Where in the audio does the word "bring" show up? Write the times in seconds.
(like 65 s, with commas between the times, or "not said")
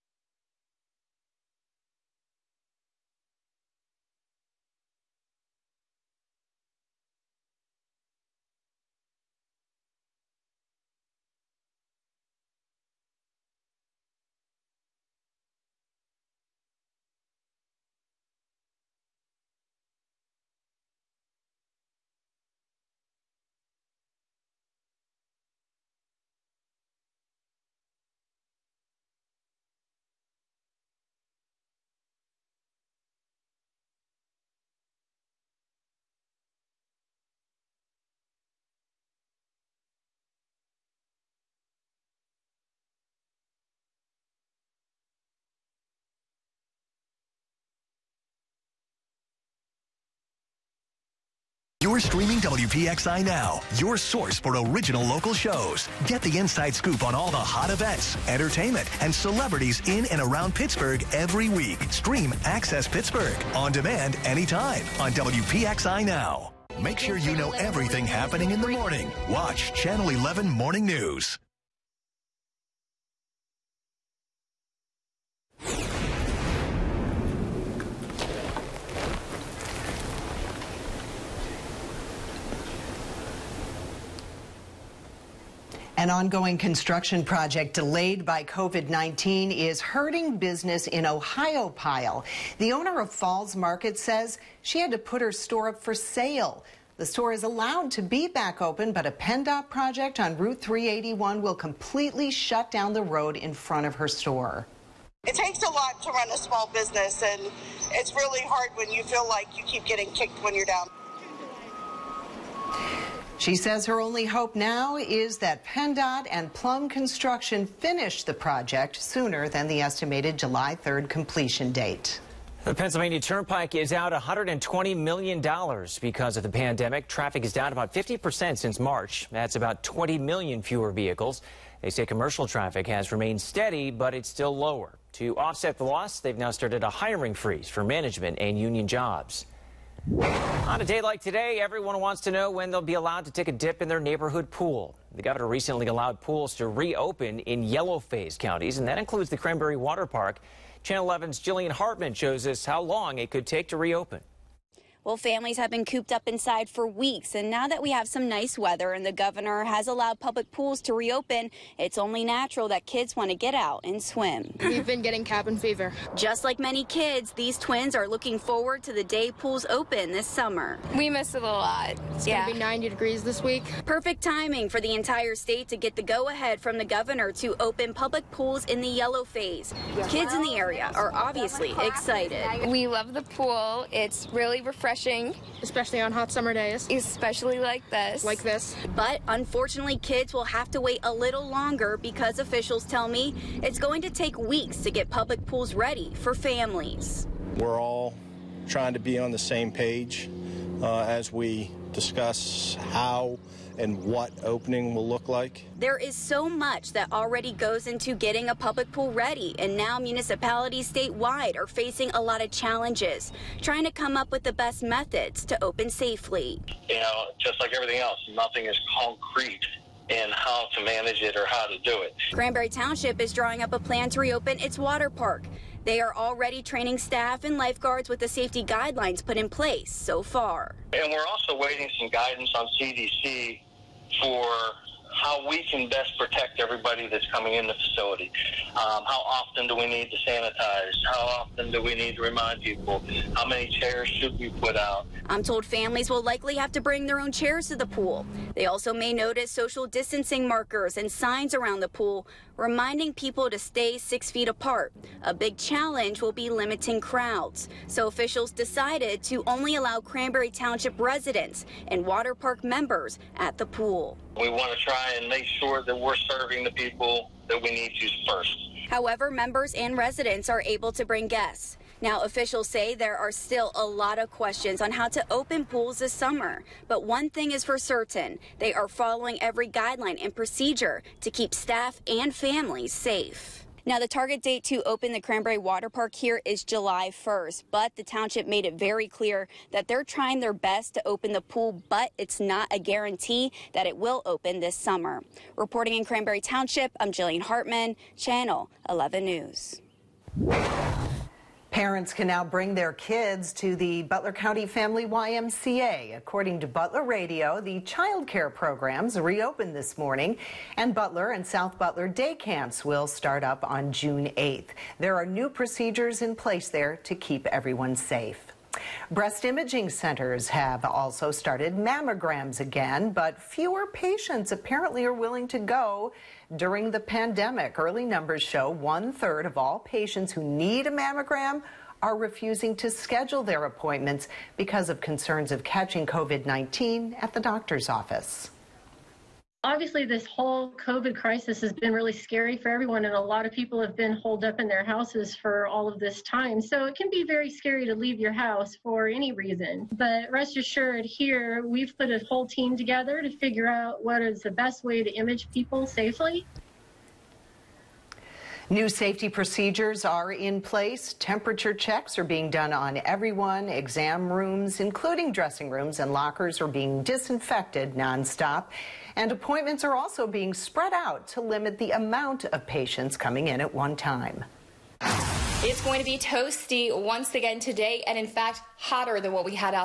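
246 s, 271 s, 302 s.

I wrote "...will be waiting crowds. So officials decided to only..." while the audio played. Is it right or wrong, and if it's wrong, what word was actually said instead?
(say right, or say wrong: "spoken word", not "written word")
wrong: "limiting", not "waiting".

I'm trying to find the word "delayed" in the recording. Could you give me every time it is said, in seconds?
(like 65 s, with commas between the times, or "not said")
87 s.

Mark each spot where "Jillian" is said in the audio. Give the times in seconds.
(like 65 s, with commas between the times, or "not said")
151 s, 297 s.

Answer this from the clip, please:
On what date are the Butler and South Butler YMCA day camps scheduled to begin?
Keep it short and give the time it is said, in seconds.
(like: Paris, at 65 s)
June 8, at 313 s.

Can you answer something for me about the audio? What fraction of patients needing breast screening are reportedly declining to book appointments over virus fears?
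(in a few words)
One third.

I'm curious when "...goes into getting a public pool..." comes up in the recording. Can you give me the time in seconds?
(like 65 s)
207 s.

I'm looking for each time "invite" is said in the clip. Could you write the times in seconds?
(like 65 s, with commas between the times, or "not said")
not said.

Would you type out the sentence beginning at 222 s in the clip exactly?
Cranberry Township is drawing up a plan to reopen its water park.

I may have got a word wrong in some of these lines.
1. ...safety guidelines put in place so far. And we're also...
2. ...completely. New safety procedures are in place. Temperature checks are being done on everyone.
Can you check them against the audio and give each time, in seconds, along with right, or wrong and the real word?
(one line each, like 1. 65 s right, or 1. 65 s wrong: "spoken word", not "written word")
1. 228 s right
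2. 355 s wrong: "safely", not "completely".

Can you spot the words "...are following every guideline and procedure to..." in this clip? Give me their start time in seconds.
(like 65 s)
278 s.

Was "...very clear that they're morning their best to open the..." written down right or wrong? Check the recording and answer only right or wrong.
wrong.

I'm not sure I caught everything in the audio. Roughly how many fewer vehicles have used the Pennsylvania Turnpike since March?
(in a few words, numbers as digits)
20 million.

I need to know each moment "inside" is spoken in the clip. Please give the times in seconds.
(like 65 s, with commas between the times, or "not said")
56 s, 156 s.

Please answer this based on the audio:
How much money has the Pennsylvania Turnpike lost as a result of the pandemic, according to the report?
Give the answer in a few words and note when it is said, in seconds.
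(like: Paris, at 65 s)
$120 million, at 124 s.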